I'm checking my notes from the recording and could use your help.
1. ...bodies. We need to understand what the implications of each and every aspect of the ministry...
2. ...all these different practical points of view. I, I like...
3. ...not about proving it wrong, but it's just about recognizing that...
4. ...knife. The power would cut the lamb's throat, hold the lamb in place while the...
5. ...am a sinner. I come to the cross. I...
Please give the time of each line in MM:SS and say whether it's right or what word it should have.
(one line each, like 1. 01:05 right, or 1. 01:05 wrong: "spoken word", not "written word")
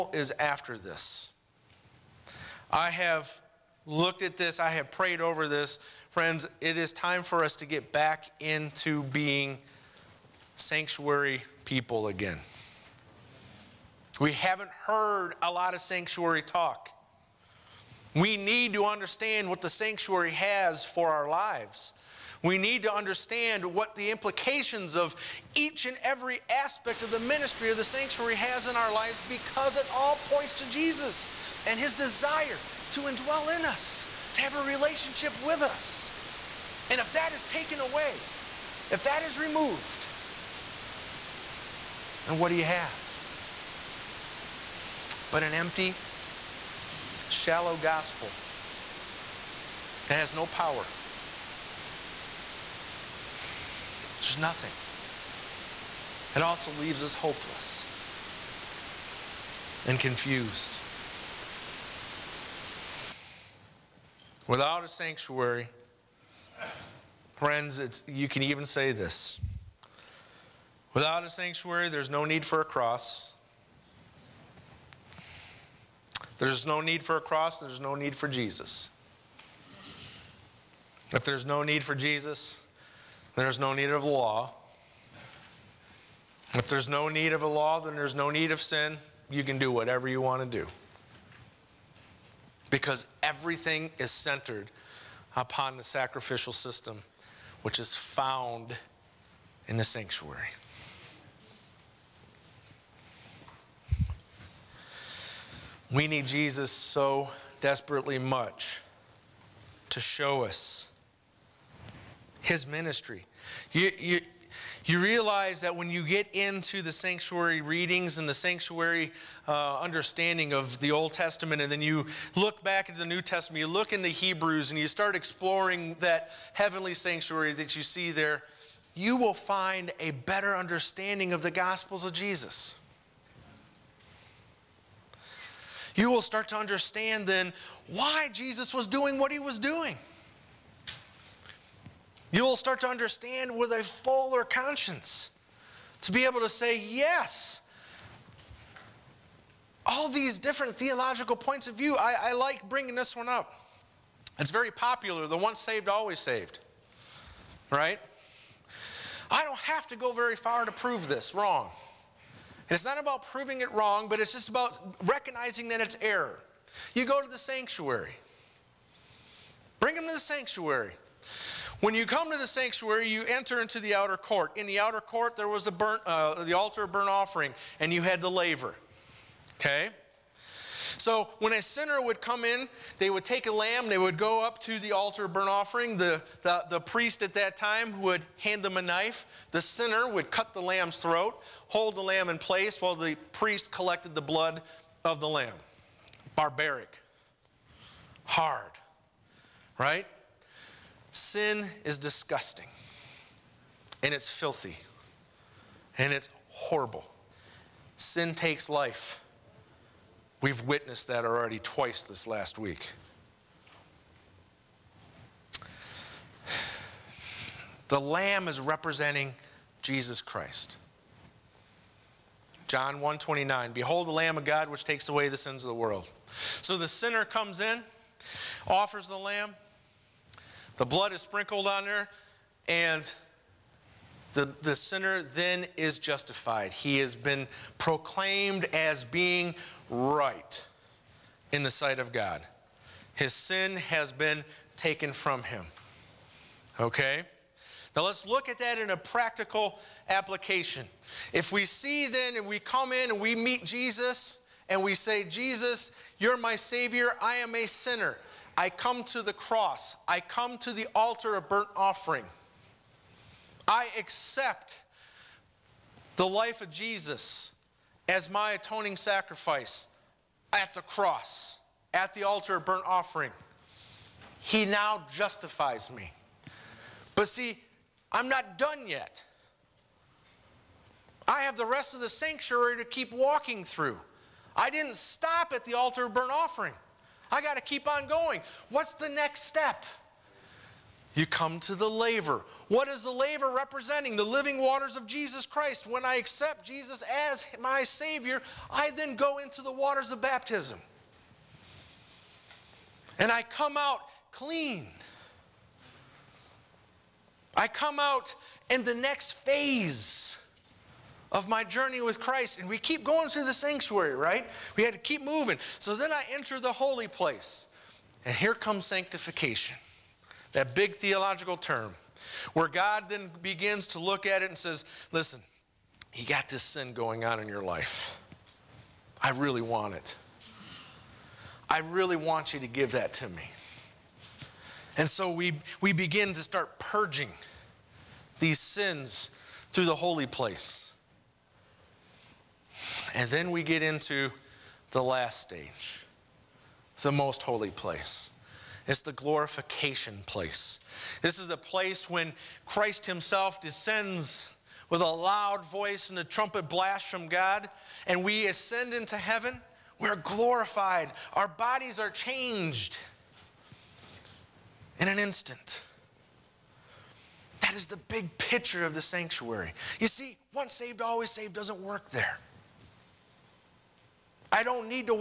1. 00:21 wrong: "lives", not "bodies"
2. 02:29 wrong: "theological", not "practical"
3. 02:42 right
4. 03:08 wrong: "sinner", not "power"
5. 04:17 right.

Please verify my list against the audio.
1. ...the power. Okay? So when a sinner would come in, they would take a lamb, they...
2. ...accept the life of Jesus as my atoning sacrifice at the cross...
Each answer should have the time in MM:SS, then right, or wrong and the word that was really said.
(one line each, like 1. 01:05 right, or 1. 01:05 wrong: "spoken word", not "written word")
1. 02:58 wrong: "laver", not "power"
2. 04:23 right.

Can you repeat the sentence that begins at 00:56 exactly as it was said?
It also leaves us hopeless and confused.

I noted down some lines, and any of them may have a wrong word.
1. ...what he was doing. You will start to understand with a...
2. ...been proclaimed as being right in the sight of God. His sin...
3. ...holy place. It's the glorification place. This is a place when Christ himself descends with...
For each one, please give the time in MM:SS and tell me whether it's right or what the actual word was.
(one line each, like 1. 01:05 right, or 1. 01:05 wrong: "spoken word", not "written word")
1. 02:19 right
2. 03:57 right
3. 05:47 right.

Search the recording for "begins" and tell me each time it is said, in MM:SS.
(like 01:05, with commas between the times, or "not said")
05:23, 05:35.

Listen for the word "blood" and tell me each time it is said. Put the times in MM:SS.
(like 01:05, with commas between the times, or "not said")
03:14, 03:50.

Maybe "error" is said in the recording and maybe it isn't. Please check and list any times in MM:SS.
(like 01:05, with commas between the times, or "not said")
02:45.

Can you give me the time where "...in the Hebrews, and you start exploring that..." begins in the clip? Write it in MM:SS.
02:03.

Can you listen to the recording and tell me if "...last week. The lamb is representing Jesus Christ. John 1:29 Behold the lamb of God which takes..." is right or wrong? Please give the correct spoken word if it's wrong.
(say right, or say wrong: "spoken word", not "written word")
right.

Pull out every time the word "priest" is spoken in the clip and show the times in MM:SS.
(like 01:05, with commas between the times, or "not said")
03:06, 03:13.